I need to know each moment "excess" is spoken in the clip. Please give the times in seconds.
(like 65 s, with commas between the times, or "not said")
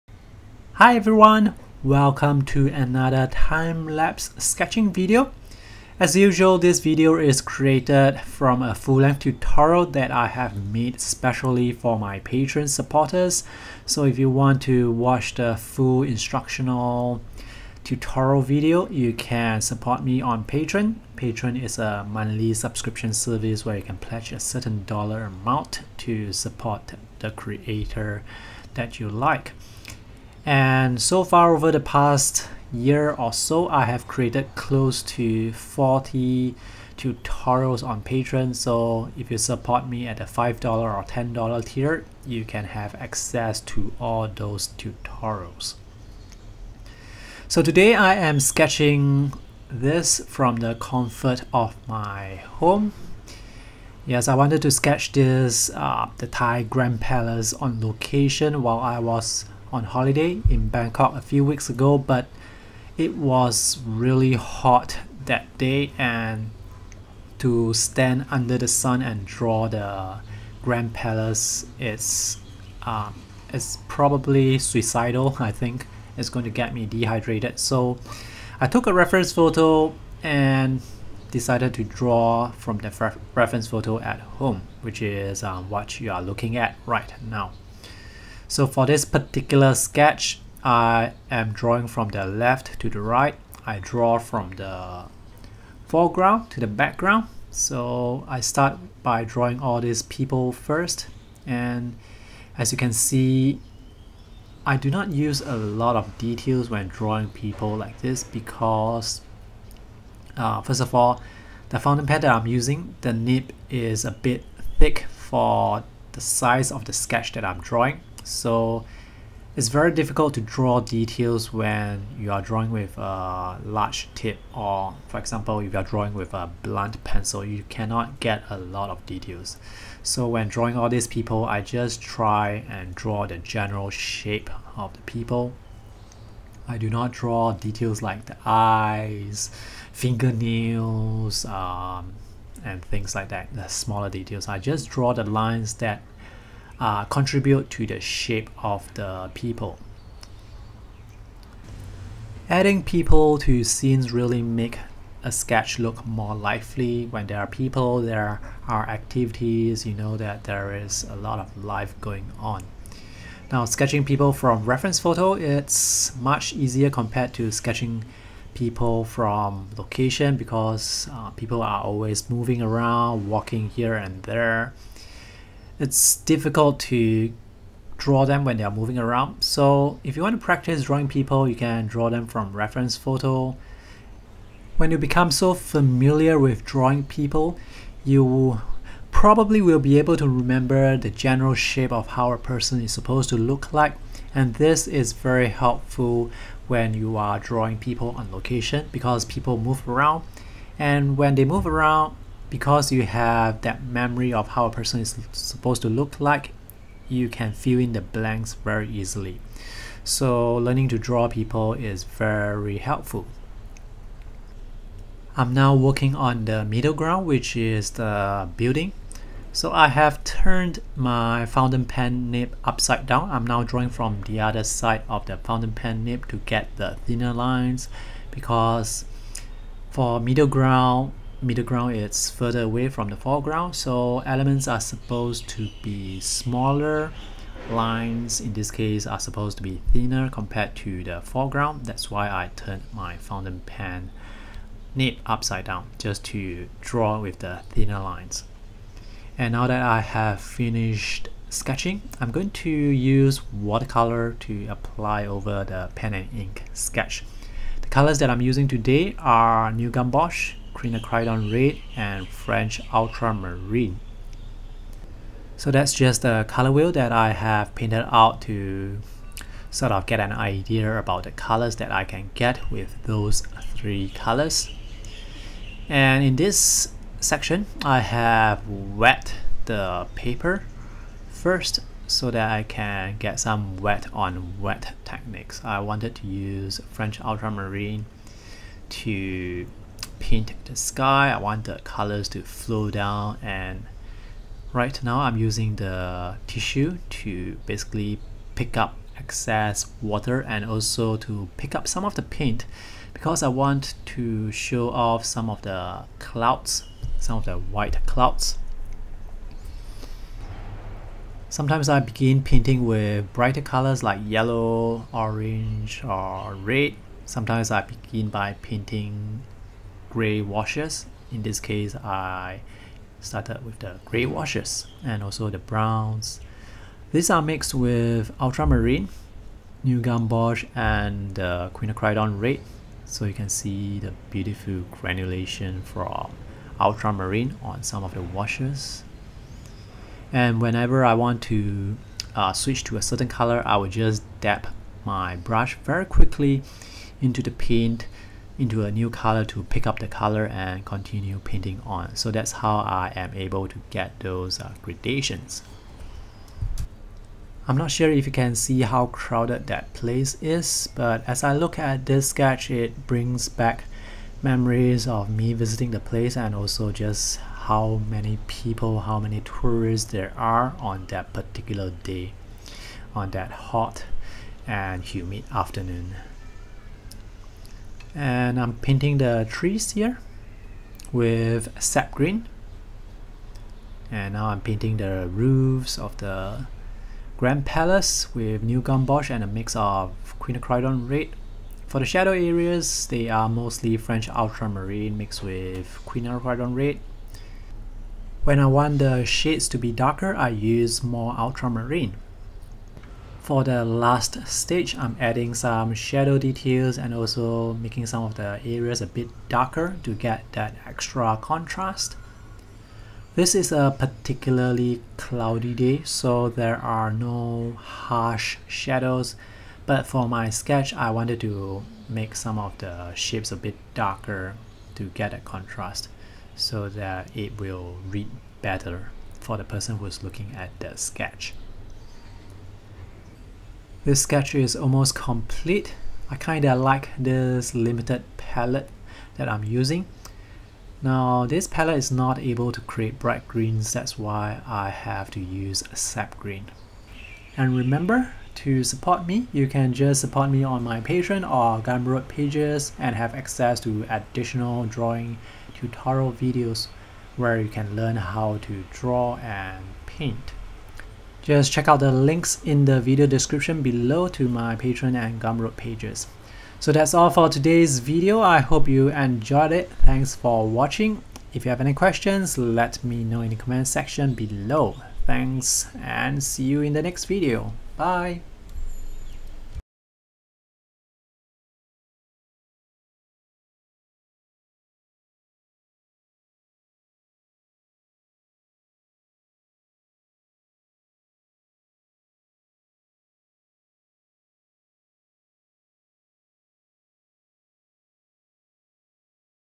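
299 s.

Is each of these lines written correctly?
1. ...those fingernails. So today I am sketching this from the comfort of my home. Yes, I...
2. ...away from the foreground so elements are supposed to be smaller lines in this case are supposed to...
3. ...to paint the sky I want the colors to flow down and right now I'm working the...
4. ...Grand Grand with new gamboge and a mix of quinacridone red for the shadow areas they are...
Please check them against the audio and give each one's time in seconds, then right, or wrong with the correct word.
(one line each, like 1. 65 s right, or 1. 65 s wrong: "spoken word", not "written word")
1. 44 s wrong: "tutorials", not "fingernails"
2. 232 s right
3. 288 s wrong: "using", not "working"
4. 387 s wrong: "Palace", not "Grand".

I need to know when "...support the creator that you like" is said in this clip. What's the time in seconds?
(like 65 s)
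26 s.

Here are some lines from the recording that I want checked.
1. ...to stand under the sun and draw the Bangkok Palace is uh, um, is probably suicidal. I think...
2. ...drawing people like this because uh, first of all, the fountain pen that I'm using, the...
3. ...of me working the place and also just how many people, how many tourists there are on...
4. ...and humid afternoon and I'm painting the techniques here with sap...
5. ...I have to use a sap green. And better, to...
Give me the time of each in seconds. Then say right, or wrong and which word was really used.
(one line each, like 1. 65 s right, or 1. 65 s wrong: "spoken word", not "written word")
1. 67 s wrong: "Grand", not "Bangkok"
2. 106 s right
3. 365 s wrong: "visiting", not "working"
4. 374 s wrong: "trees", not "techniques"
5. 444 s wrong: "remember", not "better".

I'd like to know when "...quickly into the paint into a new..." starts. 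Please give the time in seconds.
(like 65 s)
346 s.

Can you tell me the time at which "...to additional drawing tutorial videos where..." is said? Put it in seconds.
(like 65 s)
453 s.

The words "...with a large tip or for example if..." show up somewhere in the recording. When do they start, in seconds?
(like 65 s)
122 s.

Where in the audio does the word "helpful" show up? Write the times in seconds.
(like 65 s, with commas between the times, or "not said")
195 s, 212 s.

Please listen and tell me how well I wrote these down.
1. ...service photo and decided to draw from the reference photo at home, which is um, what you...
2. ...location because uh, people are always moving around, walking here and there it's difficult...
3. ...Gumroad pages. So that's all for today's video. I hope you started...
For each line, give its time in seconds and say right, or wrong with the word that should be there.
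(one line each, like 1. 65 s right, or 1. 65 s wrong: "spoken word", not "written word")
1. 78 s wrong: "reference", not "service"
2. 169 s right
3. 465 s wrong: "enjoyed", not "started".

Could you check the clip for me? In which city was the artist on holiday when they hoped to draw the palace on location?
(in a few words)
Bangkok.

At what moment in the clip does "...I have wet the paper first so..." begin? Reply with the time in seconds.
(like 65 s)
277 s.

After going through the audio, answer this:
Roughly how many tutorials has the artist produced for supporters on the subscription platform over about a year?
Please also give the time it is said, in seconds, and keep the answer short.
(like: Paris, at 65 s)
close to 40, at 34 s.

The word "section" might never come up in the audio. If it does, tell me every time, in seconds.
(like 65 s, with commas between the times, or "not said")
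277 s, 473 s.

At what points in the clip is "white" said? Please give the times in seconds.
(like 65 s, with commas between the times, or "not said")
307 s.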